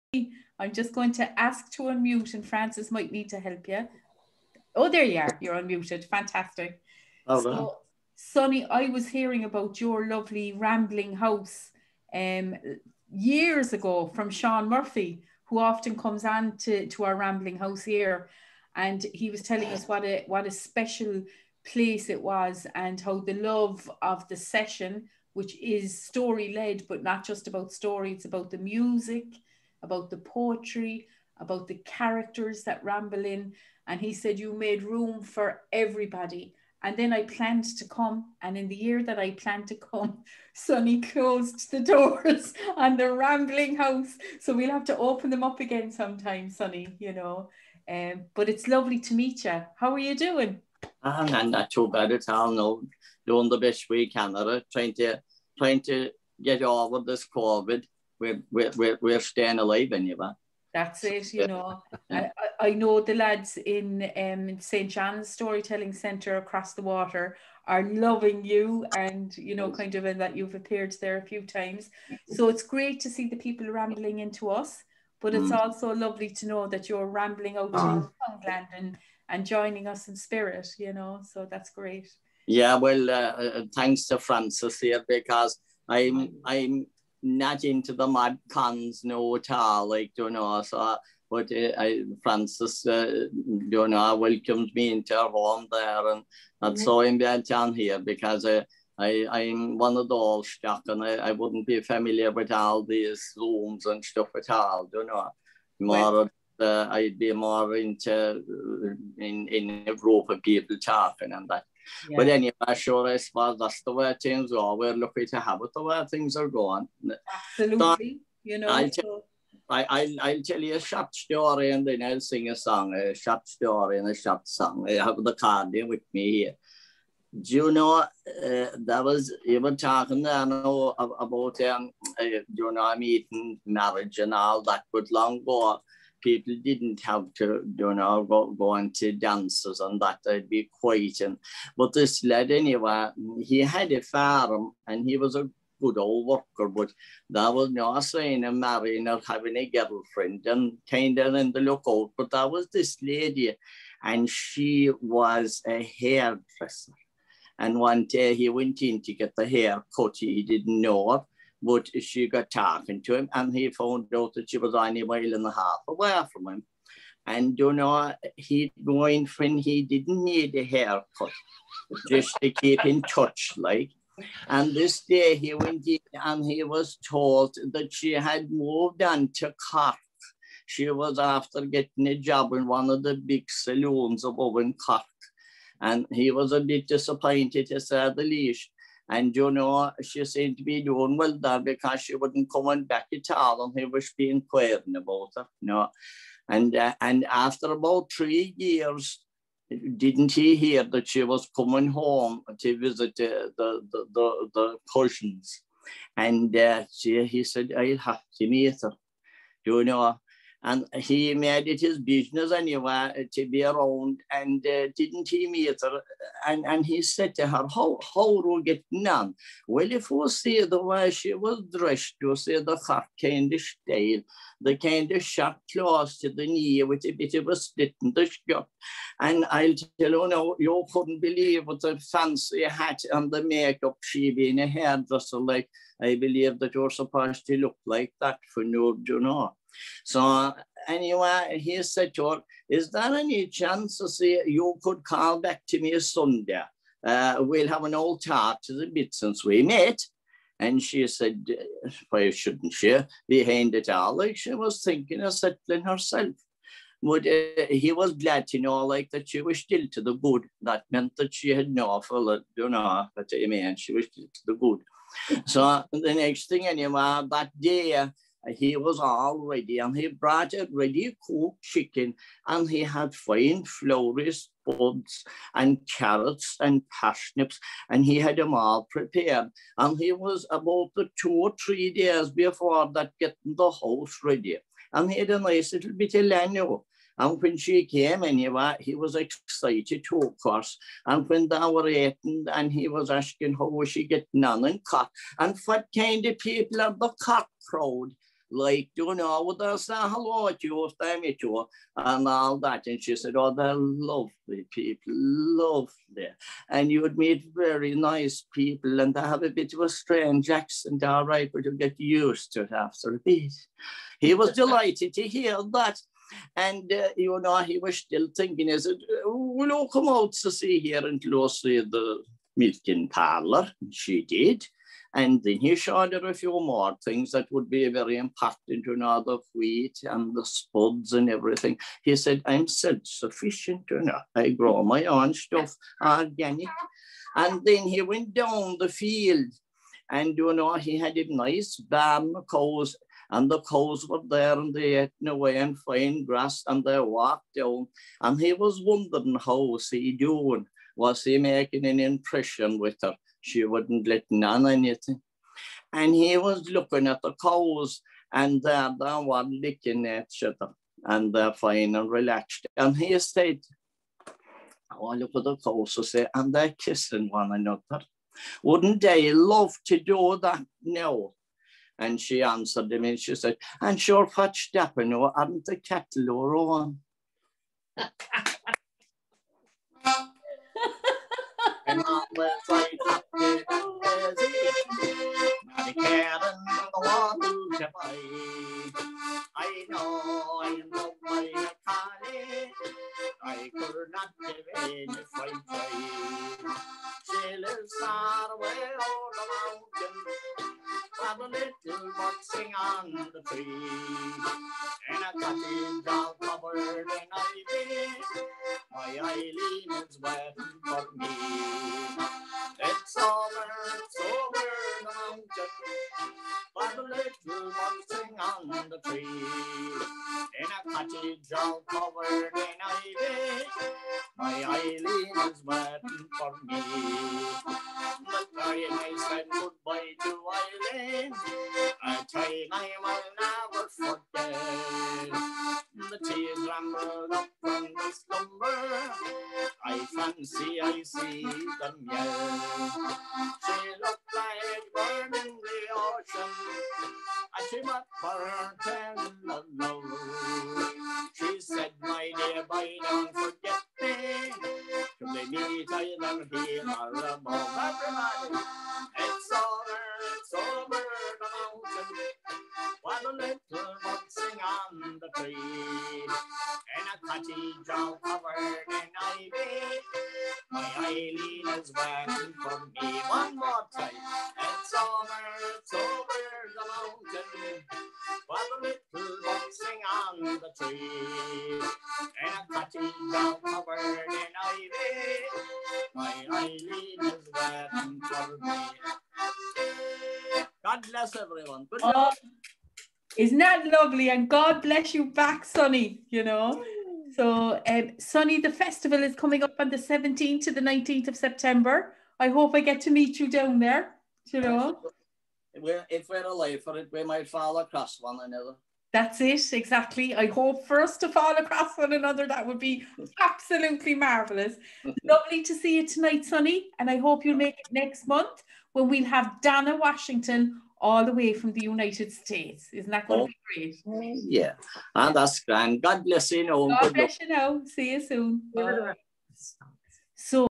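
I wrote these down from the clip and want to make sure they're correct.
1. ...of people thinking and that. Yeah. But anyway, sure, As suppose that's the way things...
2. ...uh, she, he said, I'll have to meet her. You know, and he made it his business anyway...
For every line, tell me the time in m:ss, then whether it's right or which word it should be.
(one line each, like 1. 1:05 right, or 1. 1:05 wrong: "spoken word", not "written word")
1. 1:50 wrong: "talking", not "thinking"
2. 3:26 right.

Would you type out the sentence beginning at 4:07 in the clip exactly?
Uh, we'll have an old tart to the bit since we met.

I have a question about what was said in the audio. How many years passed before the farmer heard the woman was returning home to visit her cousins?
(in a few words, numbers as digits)
About 3.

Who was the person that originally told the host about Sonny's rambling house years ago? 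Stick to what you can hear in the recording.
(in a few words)
Sean Murphy.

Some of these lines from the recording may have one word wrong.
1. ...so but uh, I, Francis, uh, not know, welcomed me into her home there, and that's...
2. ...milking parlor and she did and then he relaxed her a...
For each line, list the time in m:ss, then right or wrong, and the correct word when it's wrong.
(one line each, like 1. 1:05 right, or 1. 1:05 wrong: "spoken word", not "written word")
1. 1:30 right
2. 5:22 wrong: "showed", not "relaxed".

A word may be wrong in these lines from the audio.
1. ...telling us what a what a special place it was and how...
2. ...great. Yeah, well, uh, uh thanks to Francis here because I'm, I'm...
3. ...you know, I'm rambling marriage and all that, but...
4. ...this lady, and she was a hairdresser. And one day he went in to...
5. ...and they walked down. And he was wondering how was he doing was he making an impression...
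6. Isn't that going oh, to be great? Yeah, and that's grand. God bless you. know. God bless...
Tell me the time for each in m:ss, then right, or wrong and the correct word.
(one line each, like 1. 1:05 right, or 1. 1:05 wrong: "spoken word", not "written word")
1. 0:19 right
2. 1:21 right
3. 2:12 wrong: "eating", not "rambling"
4. 2:32 right
5. 5:46 right
6. 8:42 right.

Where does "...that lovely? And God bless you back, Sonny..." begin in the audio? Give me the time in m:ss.
8:13.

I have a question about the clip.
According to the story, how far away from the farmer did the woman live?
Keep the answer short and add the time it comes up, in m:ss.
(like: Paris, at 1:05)
A mile and a half, at 2:45.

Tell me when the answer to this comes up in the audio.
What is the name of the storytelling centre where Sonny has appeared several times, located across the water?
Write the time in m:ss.
1:04.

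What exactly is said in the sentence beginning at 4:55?
And what kind of people are the Cork crowd?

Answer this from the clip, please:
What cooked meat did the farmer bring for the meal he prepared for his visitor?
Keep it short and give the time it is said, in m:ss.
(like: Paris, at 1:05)
Chicken, at 4:31.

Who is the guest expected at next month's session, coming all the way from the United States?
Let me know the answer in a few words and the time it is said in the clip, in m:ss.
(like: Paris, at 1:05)
Dana Washington, at 8:39.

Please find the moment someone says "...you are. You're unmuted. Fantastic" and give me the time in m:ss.
0:05.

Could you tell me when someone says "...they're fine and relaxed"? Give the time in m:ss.
6:01.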